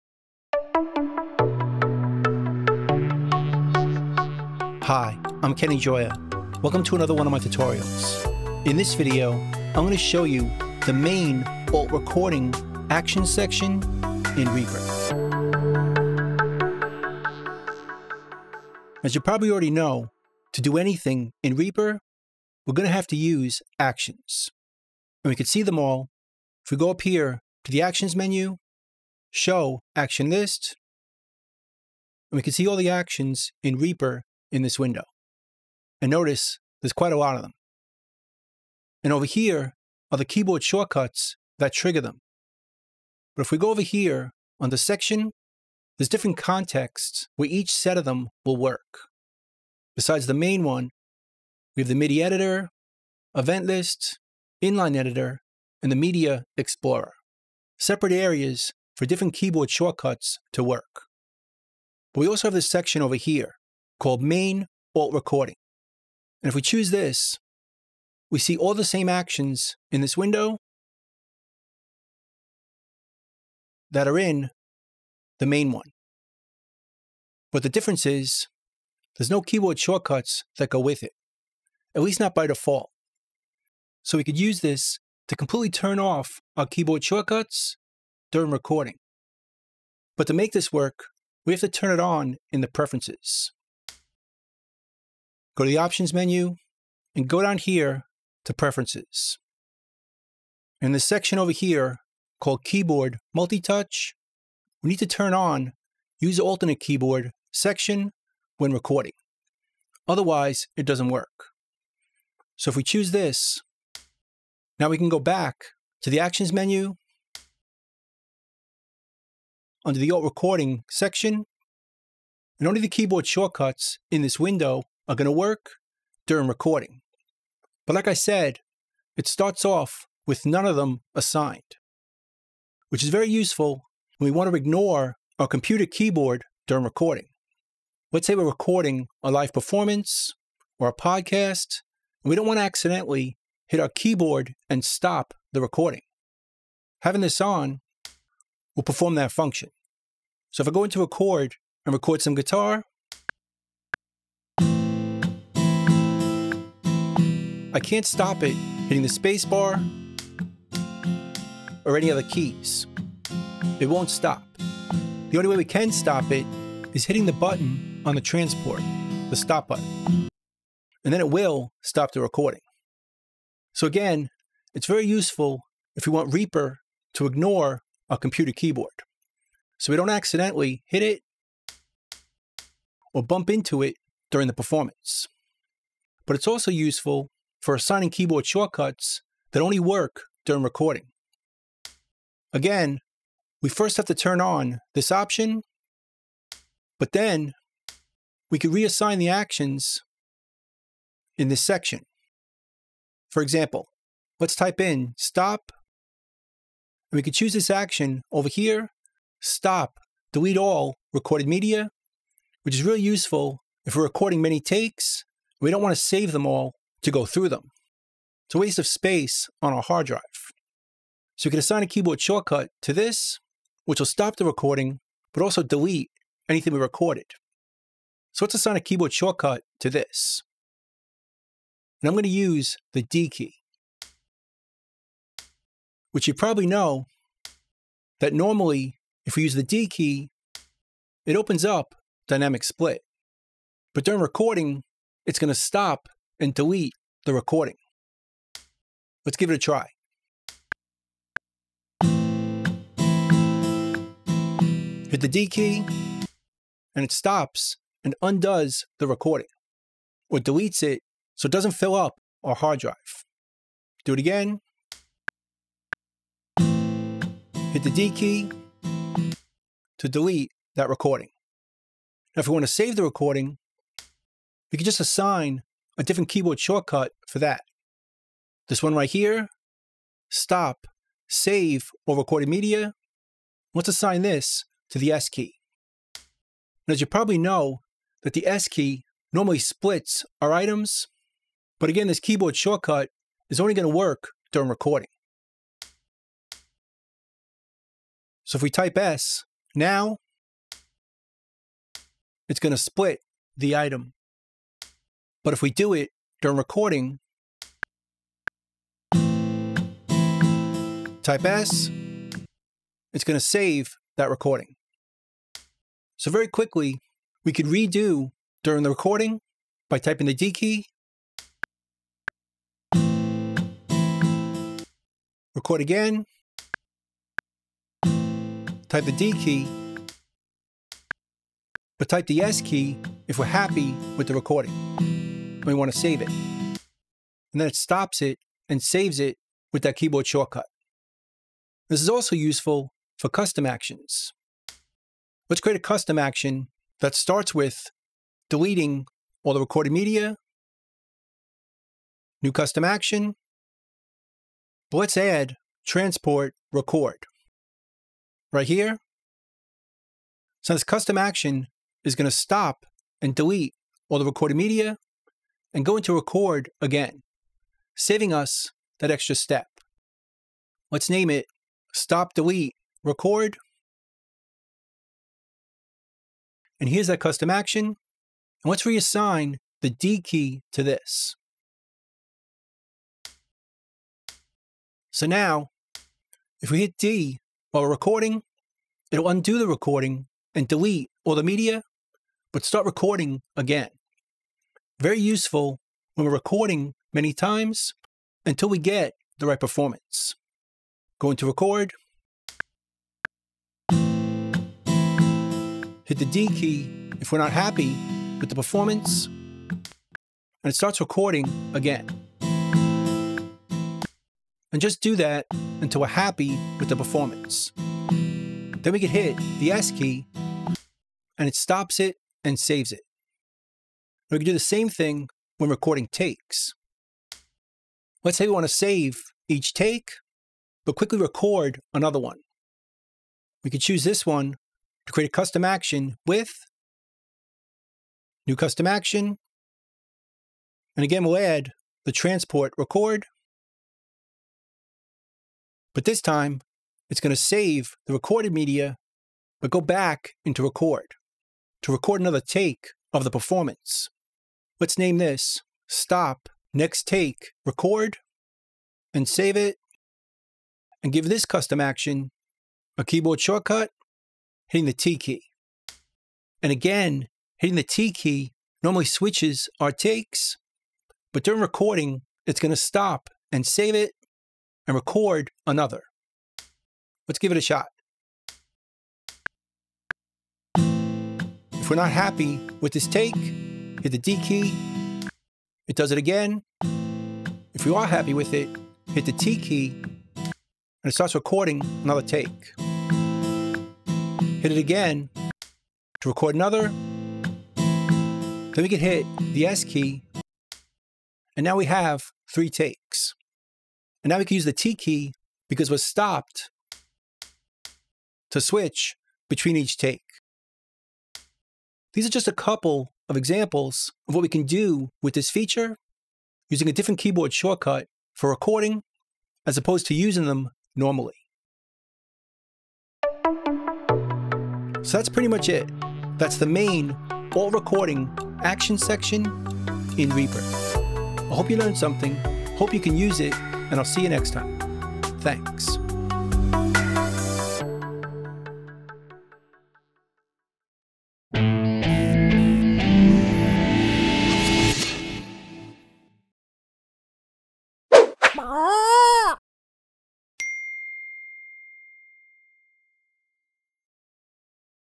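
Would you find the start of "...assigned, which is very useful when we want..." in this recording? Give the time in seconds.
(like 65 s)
131 s.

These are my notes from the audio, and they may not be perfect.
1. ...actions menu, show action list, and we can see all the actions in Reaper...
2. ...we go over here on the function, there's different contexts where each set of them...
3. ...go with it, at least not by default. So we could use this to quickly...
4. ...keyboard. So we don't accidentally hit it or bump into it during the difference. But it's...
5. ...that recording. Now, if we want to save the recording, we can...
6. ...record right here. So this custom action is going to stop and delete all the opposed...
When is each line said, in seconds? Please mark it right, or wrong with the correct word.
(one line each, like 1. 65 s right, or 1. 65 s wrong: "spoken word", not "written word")
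1. 27 s right
2. 43 s wrong: "section", not "function"
3. 80 s wrong: "completely", not "quickly"
4. 178 s wrong: "performance", not "difference"
5. 270 s right
6. 356 s wrong: "recorded", not "opposed".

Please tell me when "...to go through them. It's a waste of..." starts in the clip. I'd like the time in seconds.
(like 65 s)
217 s.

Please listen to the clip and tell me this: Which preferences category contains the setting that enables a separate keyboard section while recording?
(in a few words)
keyboard multi-touch.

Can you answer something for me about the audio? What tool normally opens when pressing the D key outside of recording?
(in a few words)
dynamic split.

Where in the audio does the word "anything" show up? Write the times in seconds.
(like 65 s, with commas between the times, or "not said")
20 s, 226 s.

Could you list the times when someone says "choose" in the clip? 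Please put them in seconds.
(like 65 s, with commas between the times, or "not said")
66 s, 112 s, 207 s, 433 s.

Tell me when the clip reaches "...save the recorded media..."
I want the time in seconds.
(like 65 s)
447 s.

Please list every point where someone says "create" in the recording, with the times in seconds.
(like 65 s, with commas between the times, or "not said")
345 s, 435 s.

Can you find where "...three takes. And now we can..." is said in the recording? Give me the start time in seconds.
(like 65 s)
502 s.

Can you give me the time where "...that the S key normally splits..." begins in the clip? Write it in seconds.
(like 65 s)
288 s.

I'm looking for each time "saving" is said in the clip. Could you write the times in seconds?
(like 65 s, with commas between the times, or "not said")
367 s.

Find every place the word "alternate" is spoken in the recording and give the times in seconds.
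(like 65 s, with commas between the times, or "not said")
106 s.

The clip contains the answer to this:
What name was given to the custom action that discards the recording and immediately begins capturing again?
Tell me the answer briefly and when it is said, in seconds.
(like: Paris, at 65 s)
stop, delete, record, at 371 s.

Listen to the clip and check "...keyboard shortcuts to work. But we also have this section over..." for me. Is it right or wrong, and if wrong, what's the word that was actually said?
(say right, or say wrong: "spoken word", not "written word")
right.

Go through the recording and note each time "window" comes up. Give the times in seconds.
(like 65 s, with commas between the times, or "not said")
34 s, 70 s, 124 s.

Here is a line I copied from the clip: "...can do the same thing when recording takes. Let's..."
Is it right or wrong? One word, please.
right.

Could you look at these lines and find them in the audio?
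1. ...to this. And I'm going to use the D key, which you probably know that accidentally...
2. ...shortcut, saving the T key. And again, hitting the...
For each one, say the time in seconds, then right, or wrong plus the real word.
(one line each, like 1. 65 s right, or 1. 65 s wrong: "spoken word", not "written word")
1. 229 s wrong: "normally", not "accidentally"
2. 463 s wrong: "hitting", not "saving".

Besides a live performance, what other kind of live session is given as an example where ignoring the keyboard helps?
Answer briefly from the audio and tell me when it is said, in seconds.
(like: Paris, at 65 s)
a podcast, at 140 s.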